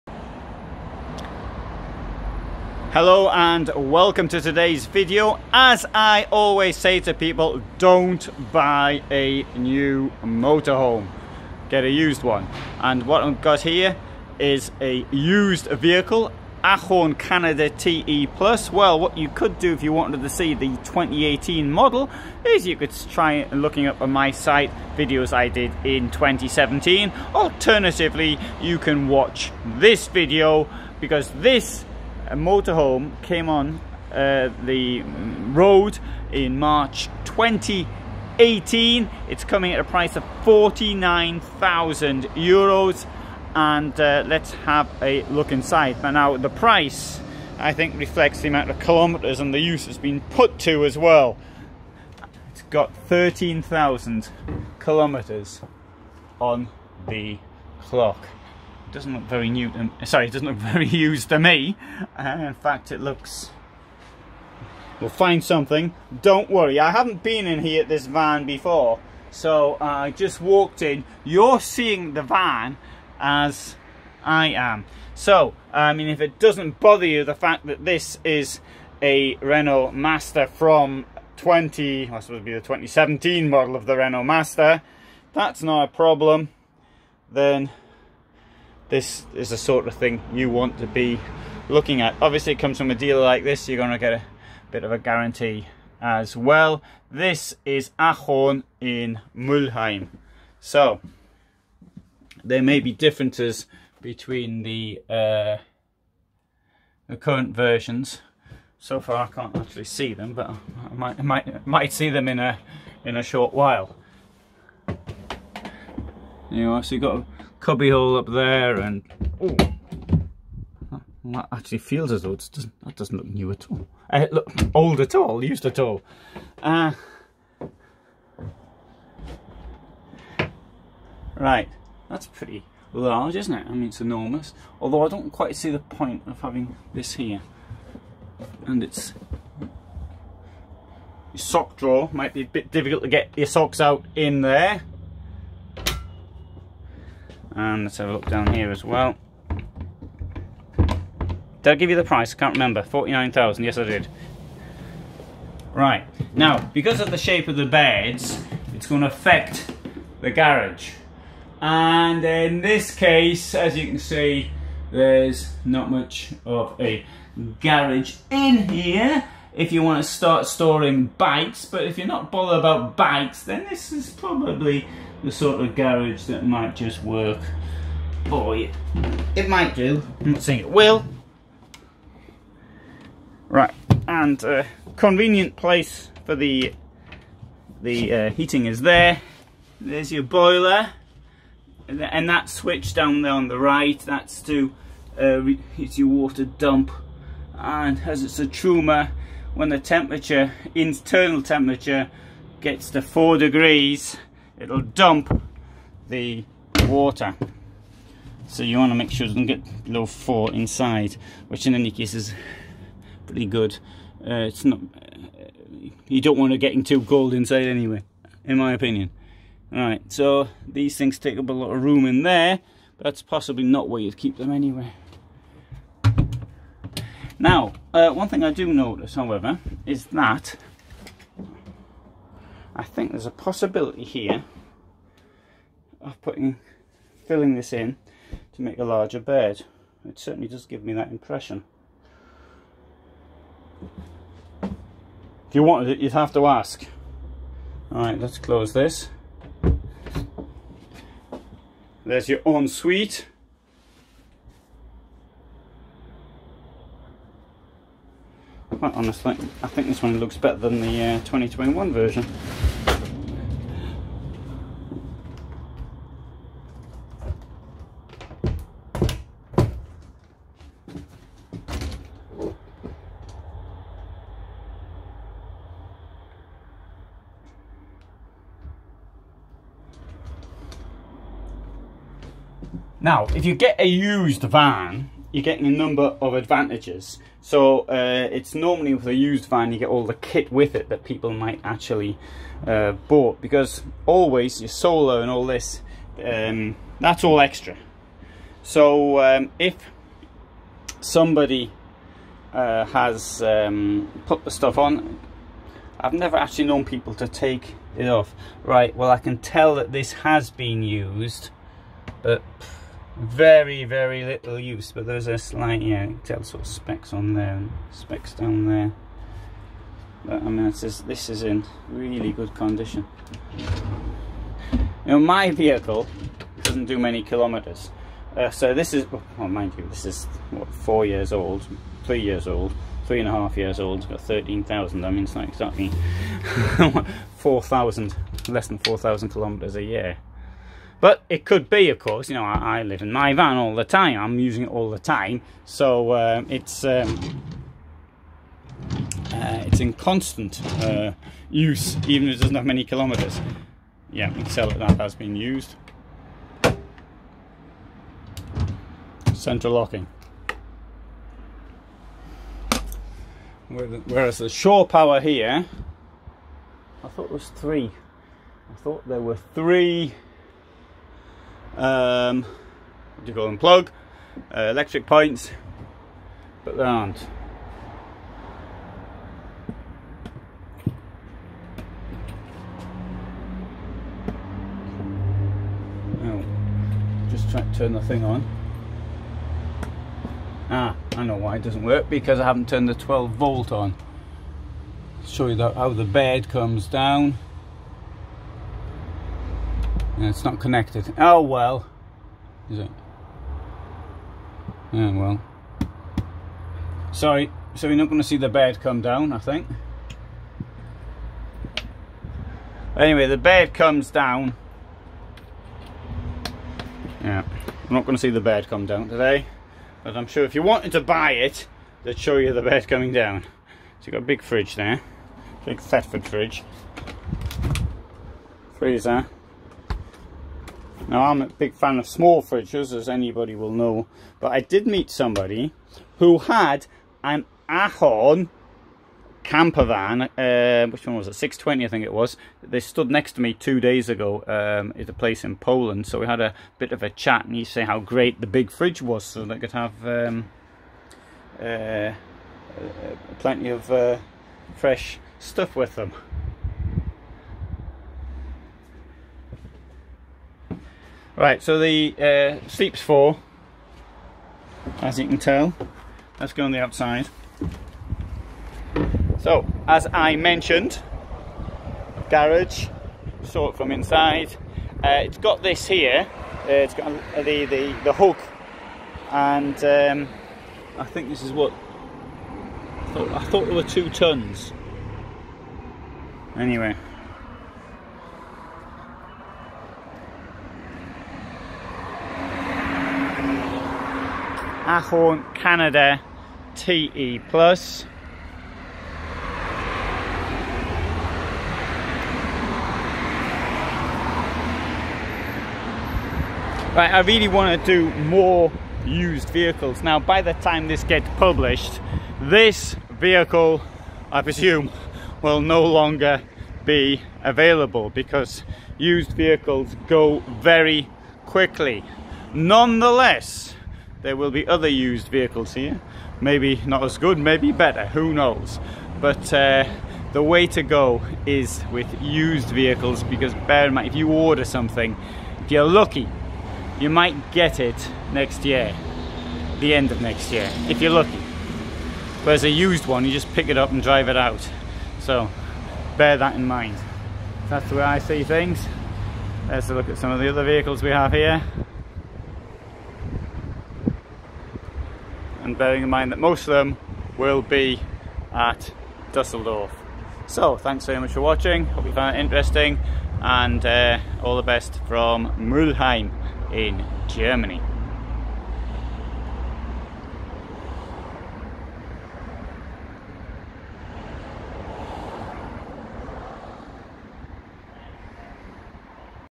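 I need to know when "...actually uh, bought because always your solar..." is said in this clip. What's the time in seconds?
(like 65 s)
291 s.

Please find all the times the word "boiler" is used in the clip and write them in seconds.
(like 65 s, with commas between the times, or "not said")
190 s.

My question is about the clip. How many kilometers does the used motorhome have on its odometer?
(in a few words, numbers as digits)
13,000.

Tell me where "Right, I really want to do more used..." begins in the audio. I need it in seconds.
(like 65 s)
506 s.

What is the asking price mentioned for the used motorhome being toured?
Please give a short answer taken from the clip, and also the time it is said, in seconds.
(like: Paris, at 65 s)
49,000 euros, at 40 s.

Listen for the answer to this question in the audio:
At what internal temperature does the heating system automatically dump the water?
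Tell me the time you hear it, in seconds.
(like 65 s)
203 s.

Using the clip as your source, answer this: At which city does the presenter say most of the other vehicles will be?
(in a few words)
Dusseldorf.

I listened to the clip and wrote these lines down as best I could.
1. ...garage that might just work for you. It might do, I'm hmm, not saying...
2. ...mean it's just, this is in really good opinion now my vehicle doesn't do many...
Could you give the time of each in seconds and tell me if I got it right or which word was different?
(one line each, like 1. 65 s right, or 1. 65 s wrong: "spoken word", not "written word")
1. 175 s right
2. 320 s wrong: "condition", not "opinion".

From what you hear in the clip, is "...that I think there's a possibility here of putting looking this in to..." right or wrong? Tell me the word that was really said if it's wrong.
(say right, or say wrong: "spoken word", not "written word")
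wrong: "filling", not "looking".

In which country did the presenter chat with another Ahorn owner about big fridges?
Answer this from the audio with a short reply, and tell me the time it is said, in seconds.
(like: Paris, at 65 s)
Poland, at 445 s.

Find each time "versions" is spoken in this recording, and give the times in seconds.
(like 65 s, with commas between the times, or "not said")
107 s, 261 s.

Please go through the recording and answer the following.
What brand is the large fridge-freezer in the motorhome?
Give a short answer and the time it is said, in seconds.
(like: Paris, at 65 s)
Thetford, at 425 s.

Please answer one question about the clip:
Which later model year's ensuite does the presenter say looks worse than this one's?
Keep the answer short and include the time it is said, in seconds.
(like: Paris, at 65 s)
2021, at 261 s.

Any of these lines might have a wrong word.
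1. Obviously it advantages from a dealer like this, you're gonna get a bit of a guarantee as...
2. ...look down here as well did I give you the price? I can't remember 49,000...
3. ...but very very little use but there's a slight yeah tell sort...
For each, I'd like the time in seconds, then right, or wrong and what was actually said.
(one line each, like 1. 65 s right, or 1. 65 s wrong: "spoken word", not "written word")
1. 92 s wrong: "comes", not "advantages"
2. 148 s right
3. 312 s right.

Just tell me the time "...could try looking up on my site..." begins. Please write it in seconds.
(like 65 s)
22 s.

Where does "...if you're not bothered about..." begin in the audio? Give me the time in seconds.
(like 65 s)
171 s.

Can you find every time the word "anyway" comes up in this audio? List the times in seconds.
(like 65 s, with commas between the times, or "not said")
217 s, 224 s, 412 s, 486 s.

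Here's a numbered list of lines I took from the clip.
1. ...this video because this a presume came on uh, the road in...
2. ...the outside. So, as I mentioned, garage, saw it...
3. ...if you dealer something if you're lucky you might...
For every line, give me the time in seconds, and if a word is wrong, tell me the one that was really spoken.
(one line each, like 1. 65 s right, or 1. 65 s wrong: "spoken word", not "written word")
1. 29 s wrong: "motorhome", not "presume"
2. 466 s right
3. 534 s wrong: "order", not "dealer".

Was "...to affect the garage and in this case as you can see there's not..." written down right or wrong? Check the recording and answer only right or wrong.
right.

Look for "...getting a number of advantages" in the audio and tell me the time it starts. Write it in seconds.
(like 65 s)
285 s.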